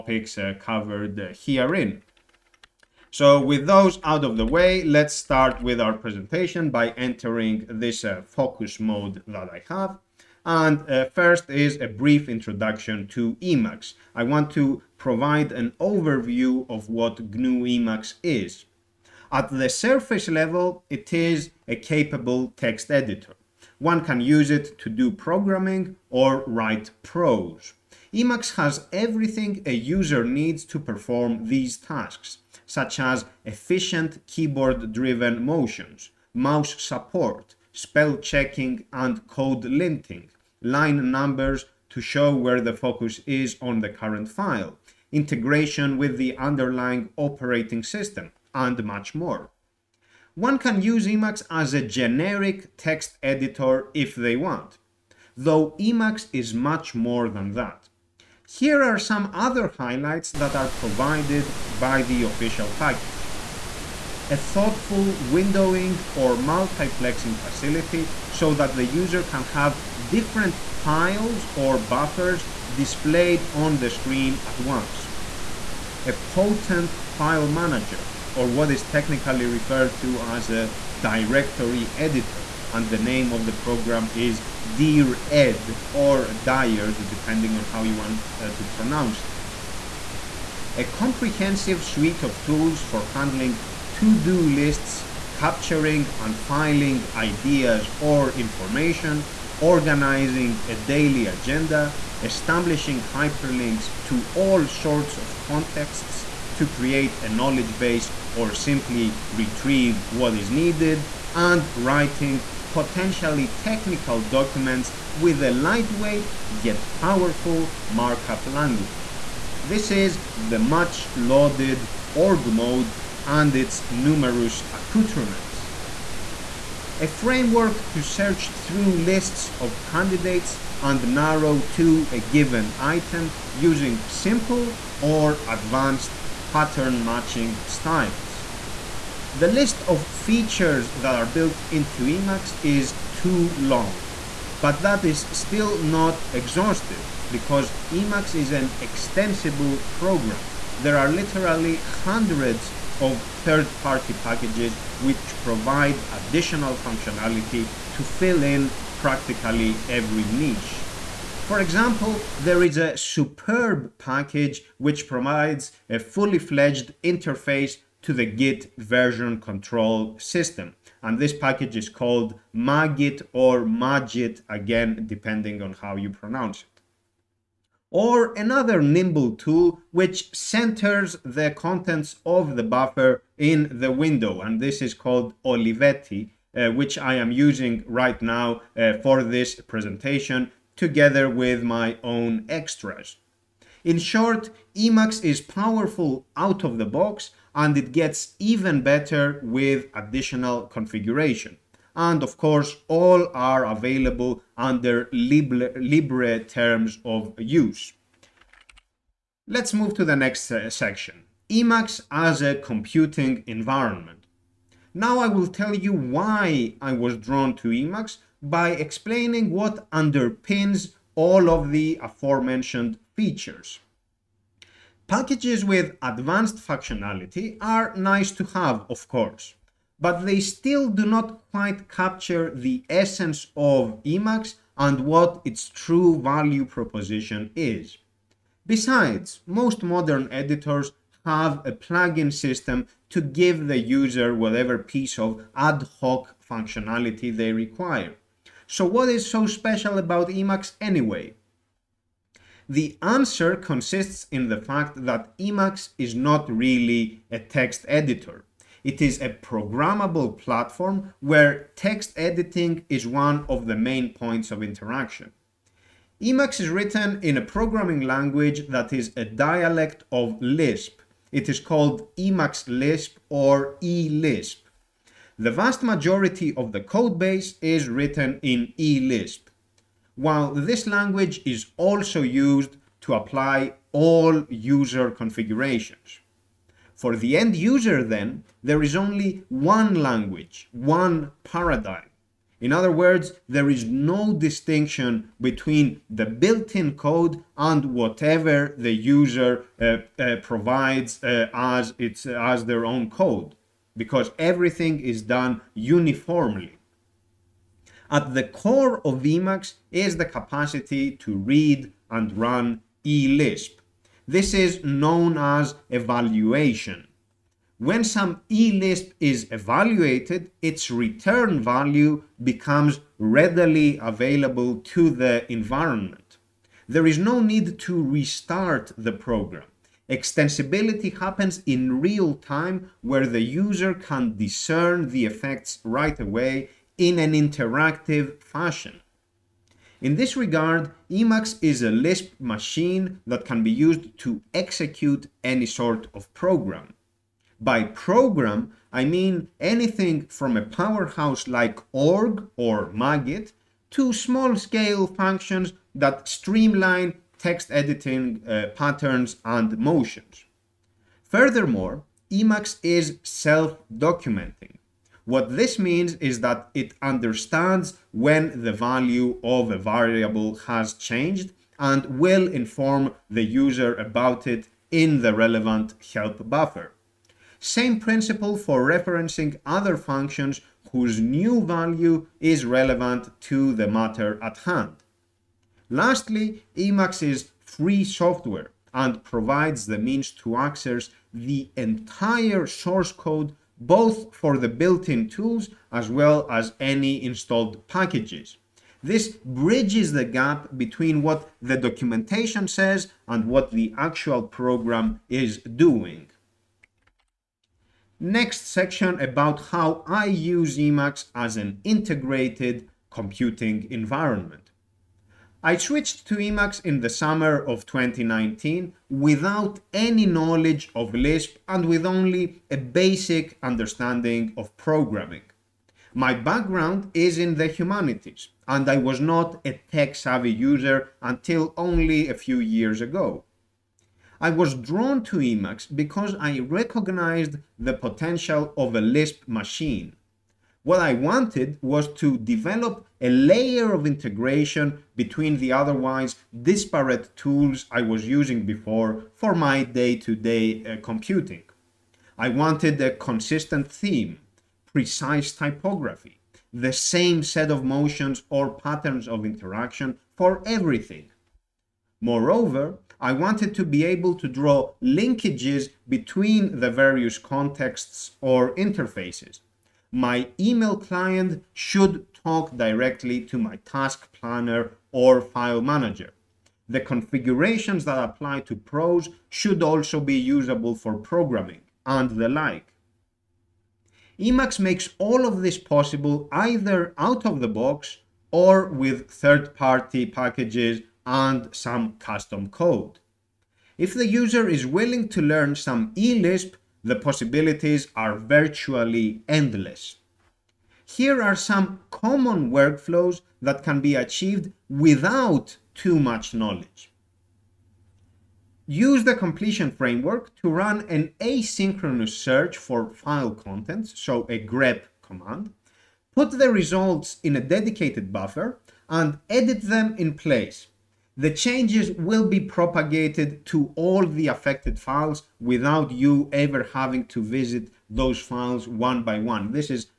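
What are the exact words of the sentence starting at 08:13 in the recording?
If the user is willing to learn some eLisp, the possibilities are virtually endless.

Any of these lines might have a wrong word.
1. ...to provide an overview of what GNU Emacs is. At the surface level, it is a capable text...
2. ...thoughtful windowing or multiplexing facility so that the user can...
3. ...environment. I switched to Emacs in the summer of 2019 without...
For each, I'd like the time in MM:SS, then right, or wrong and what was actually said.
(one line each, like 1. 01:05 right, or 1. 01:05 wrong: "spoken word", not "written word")
1. 00:14 right
2. 01:04 right
3. 06:53 right.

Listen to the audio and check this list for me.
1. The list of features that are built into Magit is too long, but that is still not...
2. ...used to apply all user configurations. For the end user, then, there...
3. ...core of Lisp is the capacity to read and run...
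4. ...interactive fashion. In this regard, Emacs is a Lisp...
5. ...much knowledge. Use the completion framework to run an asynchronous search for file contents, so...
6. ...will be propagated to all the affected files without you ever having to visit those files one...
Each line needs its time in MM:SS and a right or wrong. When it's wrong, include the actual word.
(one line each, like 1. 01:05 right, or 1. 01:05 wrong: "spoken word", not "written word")
1. 02:19 wrong: "Emacs", not "Magit"
2. 04:42 right
3. 05:08 wrong: "Emacs", not "Lisp"
4. 05:37 right
5. 08:26 right
6. 08:42 right.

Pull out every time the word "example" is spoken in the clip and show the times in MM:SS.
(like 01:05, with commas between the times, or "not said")
02:41.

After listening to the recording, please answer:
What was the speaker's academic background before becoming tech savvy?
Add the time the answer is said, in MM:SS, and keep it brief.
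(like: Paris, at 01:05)
The humanities, at 07:07.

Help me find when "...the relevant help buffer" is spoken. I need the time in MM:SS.
06:15.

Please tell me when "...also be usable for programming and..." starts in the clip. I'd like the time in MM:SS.
07:59.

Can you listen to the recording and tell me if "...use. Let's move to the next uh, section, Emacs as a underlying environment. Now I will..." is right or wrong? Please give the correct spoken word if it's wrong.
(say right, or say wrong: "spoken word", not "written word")
wrong: "computing", not "underlying".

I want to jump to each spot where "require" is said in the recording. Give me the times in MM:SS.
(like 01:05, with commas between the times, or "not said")
04:07.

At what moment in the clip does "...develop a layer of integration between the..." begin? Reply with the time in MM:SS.
07:22.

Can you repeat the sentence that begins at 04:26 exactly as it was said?
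Emacs is written in a programming language that is a dialect of Lisp.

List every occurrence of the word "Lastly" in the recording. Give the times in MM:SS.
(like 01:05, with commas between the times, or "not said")
06:25.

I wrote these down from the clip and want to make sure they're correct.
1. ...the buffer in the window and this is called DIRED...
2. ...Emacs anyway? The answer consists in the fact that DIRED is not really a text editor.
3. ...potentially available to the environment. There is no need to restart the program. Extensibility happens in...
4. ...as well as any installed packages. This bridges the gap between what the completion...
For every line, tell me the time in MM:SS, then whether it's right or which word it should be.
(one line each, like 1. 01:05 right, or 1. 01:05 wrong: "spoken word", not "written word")
1. 03:02 wrong: "Olivetti", not "DIRED"
2. 04:10 wrong: "Emacs", not "DIRED"
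3. 05:23 wrong: "readily", not "potentially"
4. 06:35 wrong: "documentation", not "completion".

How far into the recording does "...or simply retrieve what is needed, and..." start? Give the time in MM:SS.
01:48.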